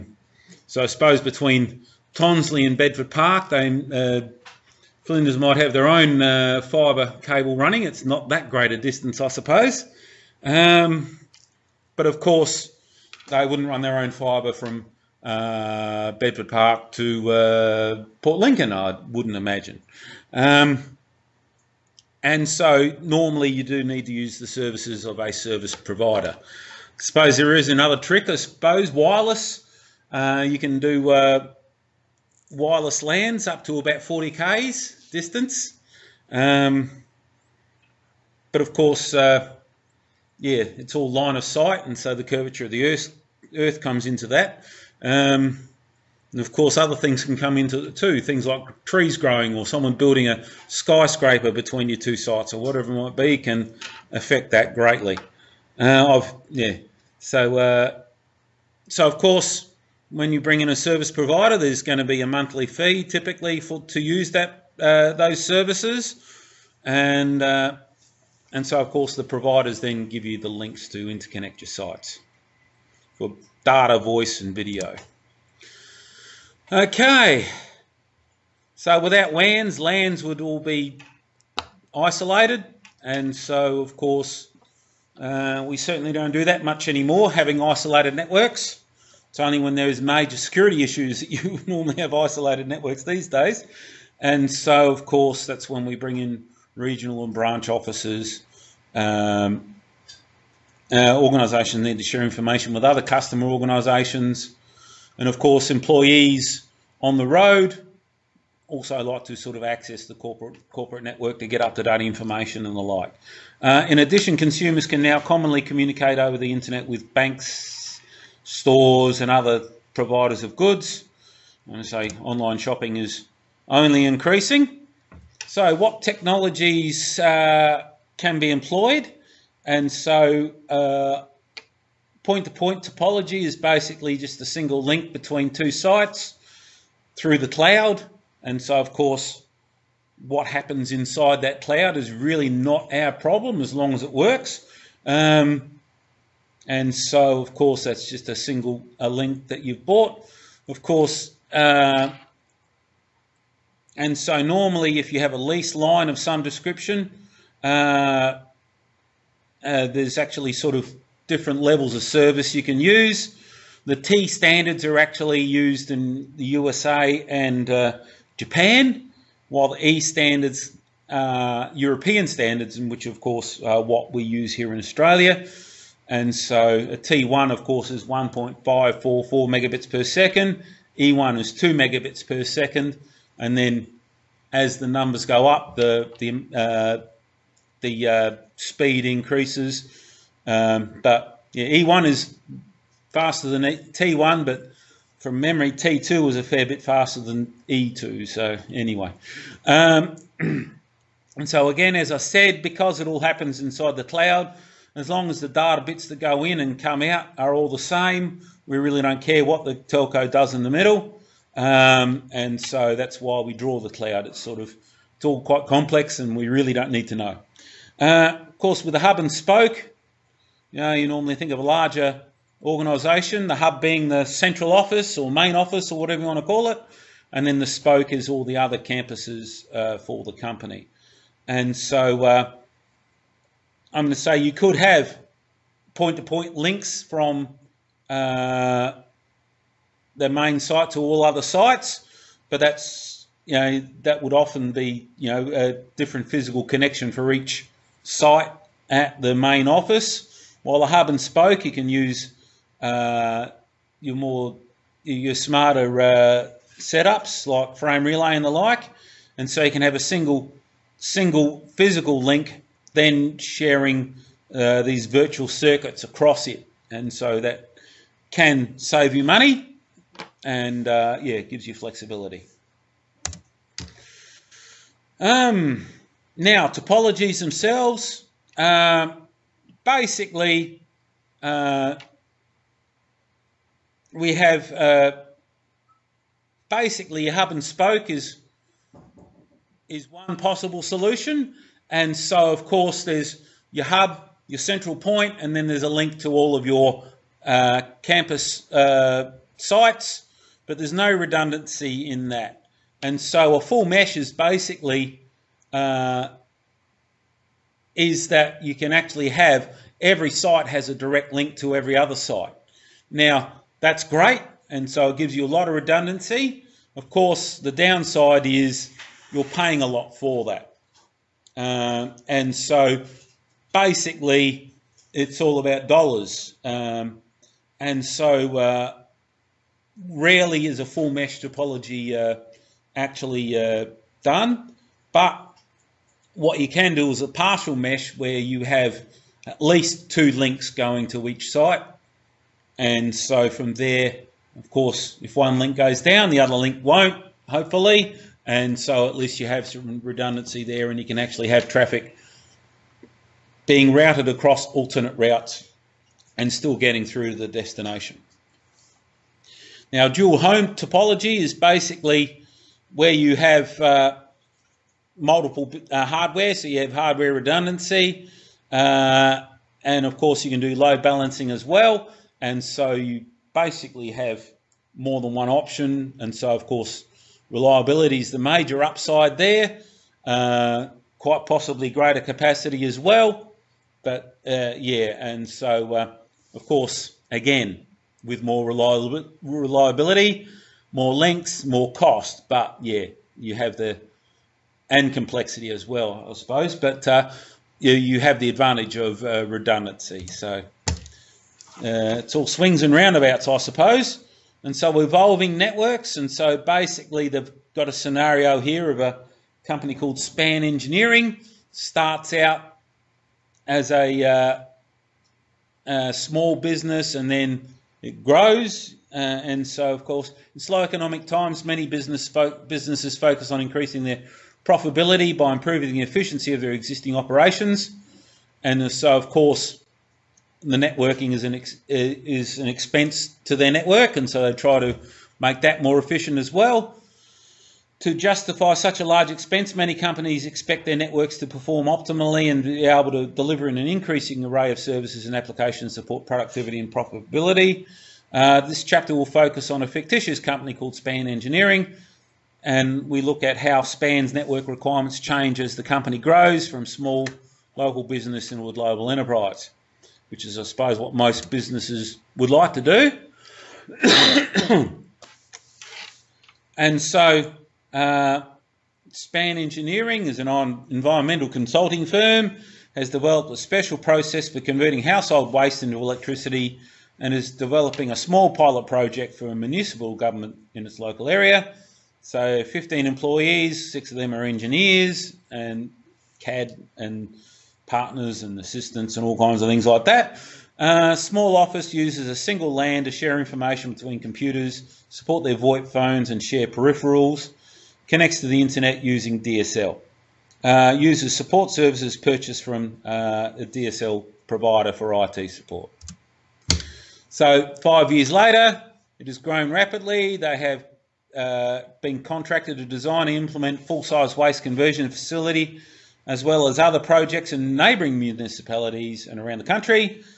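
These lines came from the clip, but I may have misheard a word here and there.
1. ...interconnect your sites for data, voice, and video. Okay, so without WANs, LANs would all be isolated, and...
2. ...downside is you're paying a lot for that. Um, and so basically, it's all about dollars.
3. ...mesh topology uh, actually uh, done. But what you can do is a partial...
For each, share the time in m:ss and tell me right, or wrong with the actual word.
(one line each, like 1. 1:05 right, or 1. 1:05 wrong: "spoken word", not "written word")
1. 1:11 right
2. 5:17 right
3. 5:31 right.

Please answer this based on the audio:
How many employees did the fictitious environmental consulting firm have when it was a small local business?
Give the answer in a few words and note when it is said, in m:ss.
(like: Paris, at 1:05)
15, at 8:02.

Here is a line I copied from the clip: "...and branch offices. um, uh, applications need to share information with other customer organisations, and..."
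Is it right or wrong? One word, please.
wrong.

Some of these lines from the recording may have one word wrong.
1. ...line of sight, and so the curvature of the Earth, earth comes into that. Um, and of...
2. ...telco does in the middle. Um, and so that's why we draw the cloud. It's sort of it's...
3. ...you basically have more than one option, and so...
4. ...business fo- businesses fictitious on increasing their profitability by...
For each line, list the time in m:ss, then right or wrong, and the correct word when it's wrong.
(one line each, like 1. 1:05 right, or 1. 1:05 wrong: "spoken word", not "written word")
1. 0:41 right
2. 3:29 right
3. 6:12 right
4. 7:01 wrong: "focus", not "fictitious".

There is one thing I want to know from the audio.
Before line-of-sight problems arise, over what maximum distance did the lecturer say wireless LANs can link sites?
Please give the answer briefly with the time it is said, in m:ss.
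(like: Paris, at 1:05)
40 km, at 0:34.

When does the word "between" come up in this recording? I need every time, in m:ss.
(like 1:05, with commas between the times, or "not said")
0:01, 0:51, 2:15, 8:13.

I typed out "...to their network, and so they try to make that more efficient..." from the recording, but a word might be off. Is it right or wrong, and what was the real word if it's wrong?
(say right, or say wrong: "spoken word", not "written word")
right.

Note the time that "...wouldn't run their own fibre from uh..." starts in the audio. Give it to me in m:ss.
0:13.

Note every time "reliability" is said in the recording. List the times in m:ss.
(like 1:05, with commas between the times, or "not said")
6:17, 6:28.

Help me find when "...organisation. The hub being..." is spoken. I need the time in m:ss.
3:42.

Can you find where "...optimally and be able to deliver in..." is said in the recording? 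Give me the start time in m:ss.
7:21.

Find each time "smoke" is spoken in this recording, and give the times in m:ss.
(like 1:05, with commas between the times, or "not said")
not said.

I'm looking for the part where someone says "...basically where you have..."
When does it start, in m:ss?
6:01.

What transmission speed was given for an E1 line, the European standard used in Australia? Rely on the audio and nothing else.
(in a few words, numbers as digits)
2 megabits per second.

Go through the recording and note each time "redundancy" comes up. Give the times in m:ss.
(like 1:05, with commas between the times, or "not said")
5:01, 5:15, 5:50, 6:07, 6:39.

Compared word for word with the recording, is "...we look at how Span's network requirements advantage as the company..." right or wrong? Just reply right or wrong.
wrong.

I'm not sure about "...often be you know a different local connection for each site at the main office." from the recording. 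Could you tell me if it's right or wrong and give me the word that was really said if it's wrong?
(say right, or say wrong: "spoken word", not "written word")
wrong: "physical", not "local".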